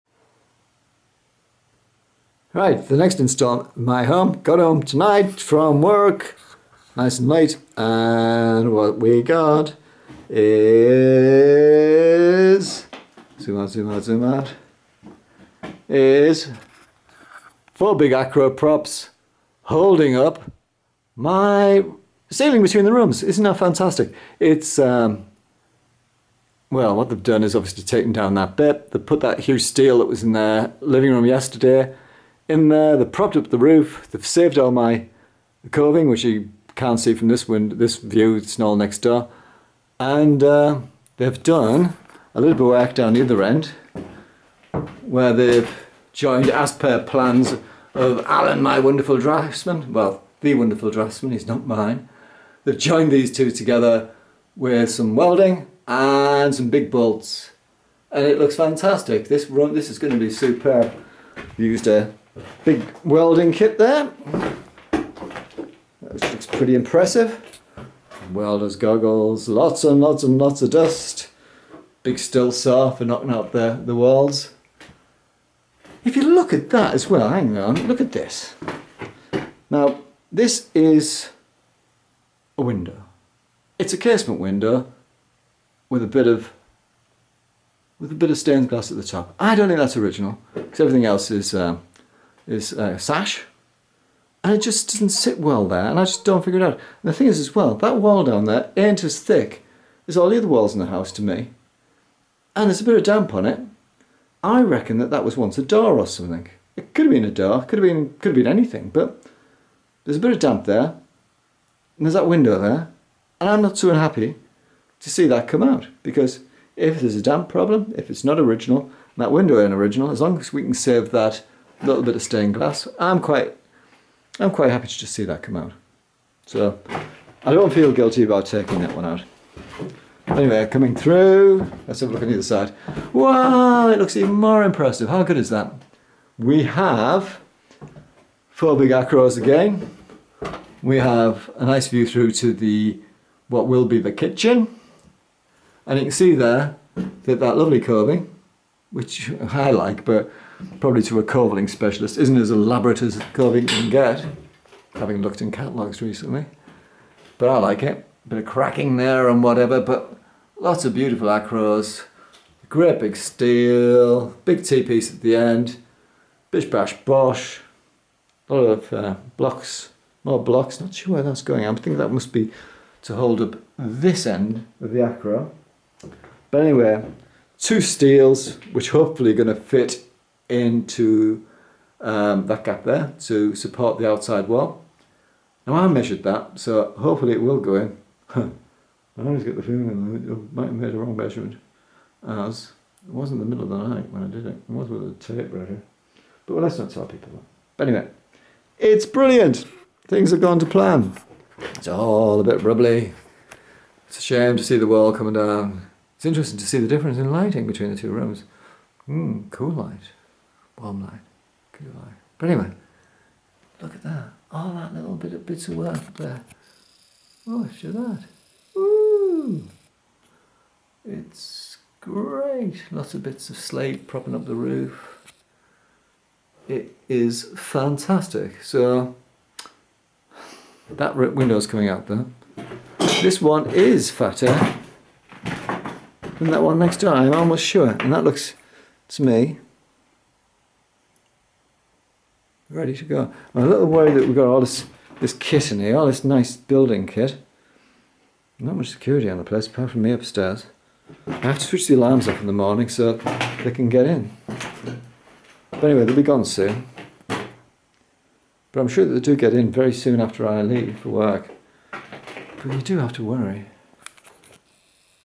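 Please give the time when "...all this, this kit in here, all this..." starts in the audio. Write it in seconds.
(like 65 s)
244 s.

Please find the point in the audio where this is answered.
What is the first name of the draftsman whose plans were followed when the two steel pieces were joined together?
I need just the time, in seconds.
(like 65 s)
48 s.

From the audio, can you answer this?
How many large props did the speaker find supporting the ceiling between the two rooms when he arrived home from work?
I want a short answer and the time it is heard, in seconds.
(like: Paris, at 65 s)
4, at 17 s.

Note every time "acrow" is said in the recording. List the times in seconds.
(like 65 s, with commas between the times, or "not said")
18 s, 138 s, 161 s, 174 s.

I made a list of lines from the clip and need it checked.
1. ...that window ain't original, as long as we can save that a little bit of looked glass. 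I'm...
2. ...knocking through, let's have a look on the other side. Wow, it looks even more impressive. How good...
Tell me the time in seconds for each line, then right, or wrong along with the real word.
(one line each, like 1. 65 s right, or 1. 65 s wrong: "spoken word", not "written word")
1. 119 s wrong: "stained", not "looked"
2. 130 s wrong: "coming", not "knocking".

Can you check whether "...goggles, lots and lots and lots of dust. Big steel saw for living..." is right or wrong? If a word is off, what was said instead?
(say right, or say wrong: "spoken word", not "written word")
wrong: "knocking", not "living".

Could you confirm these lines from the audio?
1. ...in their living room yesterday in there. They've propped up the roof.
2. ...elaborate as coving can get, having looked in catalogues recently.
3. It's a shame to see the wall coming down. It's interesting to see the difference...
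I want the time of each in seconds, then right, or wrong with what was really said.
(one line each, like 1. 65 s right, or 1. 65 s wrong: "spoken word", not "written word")
1. 30 s right
2. 152 s right
3. 204 s right.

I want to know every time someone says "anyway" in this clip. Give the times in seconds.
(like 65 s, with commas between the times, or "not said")
130 s, 176 s, 197 s, 212 s, 255 s.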